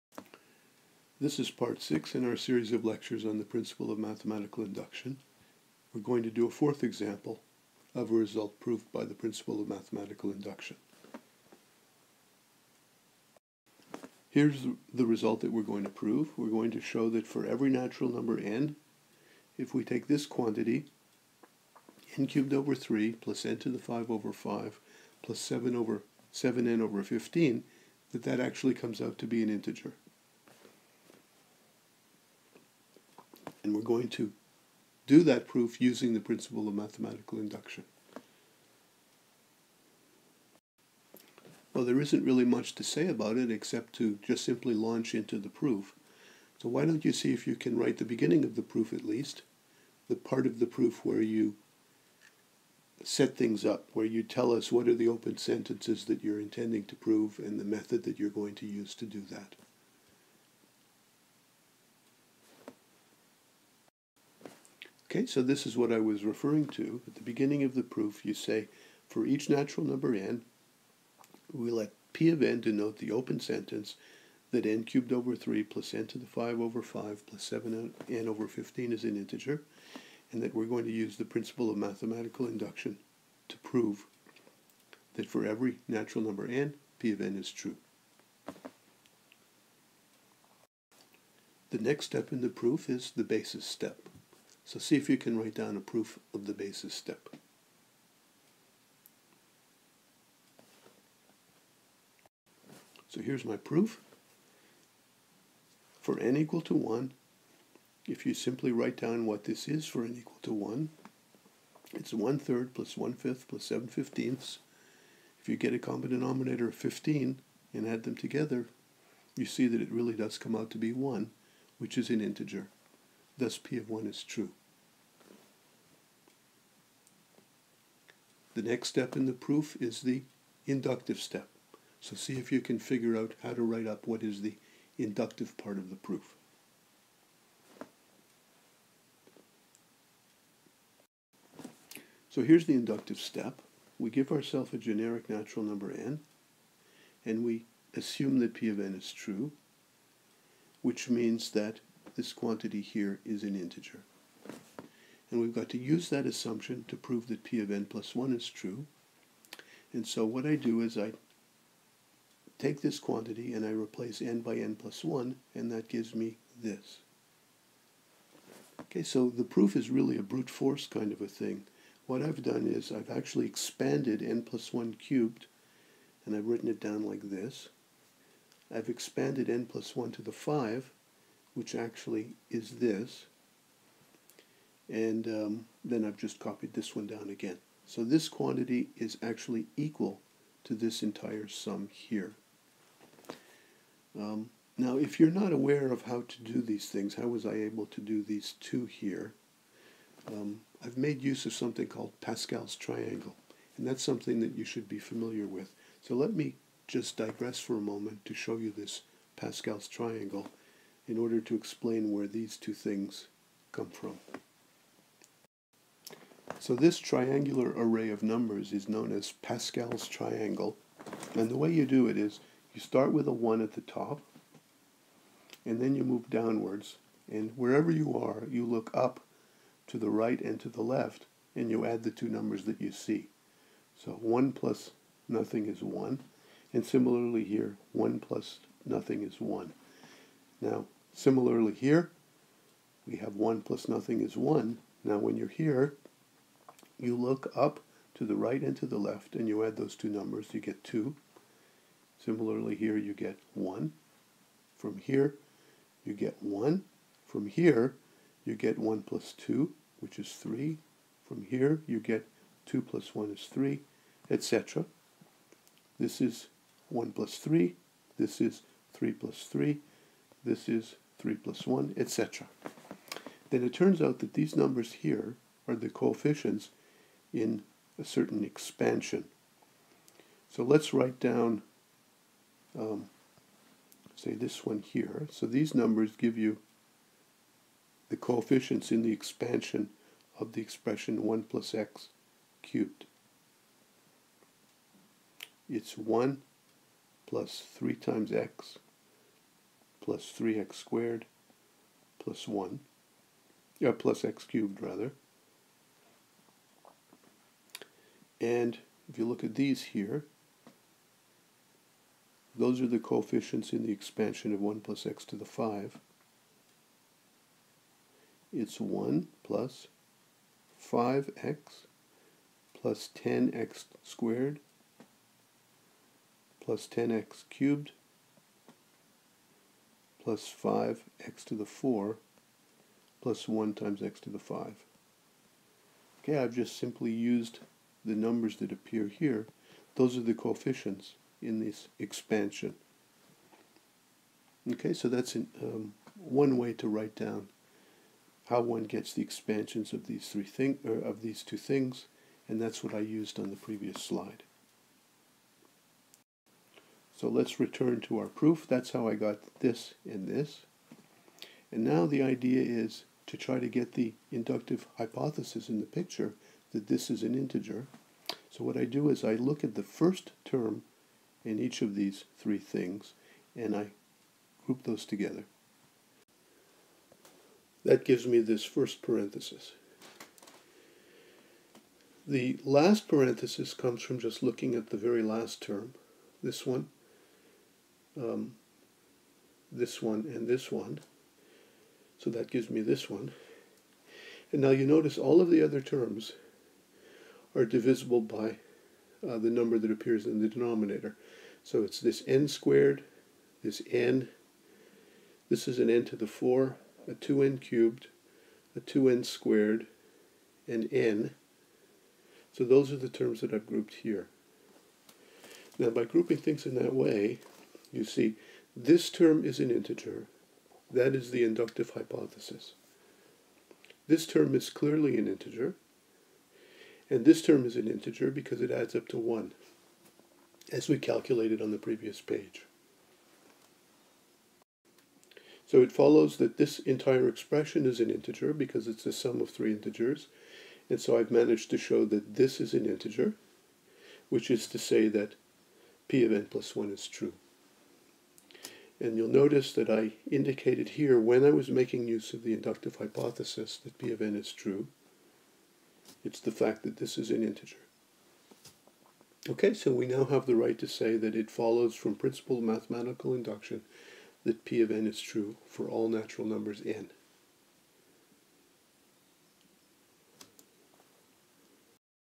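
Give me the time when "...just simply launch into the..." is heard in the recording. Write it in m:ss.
0:44.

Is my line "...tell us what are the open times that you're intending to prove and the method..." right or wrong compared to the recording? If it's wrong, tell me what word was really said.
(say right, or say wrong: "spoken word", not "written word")
wrong: "sentences", not "times".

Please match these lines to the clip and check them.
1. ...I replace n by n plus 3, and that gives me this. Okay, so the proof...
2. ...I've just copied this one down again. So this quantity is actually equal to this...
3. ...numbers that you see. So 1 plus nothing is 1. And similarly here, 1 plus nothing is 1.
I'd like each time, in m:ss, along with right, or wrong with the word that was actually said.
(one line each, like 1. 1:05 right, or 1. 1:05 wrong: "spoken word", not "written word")
1. 2:43 wrong: "1", not "3"
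2. 3:06 right
3. 3:52 right.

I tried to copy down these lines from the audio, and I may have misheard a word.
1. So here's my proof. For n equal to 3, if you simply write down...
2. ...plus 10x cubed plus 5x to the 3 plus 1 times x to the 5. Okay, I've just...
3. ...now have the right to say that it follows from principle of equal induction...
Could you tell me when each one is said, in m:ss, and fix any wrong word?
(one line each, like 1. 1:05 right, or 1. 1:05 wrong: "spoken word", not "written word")
1. 1:43 wrong: "1", not "3"
2. 5:26 wrong: "4", not "3"
3. 7:40 wrong: "mathematical", not "equal".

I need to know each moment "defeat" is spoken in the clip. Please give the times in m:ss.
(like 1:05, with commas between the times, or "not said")
not said.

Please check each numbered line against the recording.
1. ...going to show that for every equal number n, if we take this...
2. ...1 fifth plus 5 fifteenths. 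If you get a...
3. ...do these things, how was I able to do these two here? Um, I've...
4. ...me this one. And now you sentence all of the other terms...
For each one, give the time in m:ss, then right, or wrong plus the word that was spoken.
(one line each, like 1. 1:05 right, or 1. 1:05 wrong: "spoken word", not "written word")
1. 0:16 wrong: "natural", not "equal"
2. 1:52 wrong: "7", not "5"
3. 3:16 right
4. 6:32 wrong: "notice", not "sentence".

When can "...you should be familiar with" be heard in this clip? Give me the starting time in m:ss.
3:24.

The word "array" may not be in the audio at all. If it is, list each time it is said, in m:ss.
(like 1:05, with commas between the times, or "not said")
3:37.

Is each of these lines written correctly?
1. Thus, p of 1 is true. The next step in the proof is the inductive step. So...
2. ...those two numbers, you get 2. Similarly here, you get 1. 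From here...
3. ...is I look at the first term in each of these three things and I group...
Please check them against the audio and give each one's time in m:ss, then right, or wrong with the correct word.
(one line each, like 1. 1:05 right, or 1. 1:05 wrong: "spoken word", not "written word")
1. 2:03 right
2. 4:09 right
3. 6:09 right.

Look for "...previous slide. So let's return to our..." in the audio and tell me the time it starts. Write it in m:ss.
5:53.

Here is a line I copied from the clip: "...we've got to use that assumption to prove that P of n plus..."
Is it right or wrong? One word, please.
right.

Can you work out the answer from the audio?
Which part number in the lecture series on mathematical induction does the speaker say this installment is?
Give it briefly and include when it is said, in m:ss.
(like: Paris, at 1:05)
six, at 0:01.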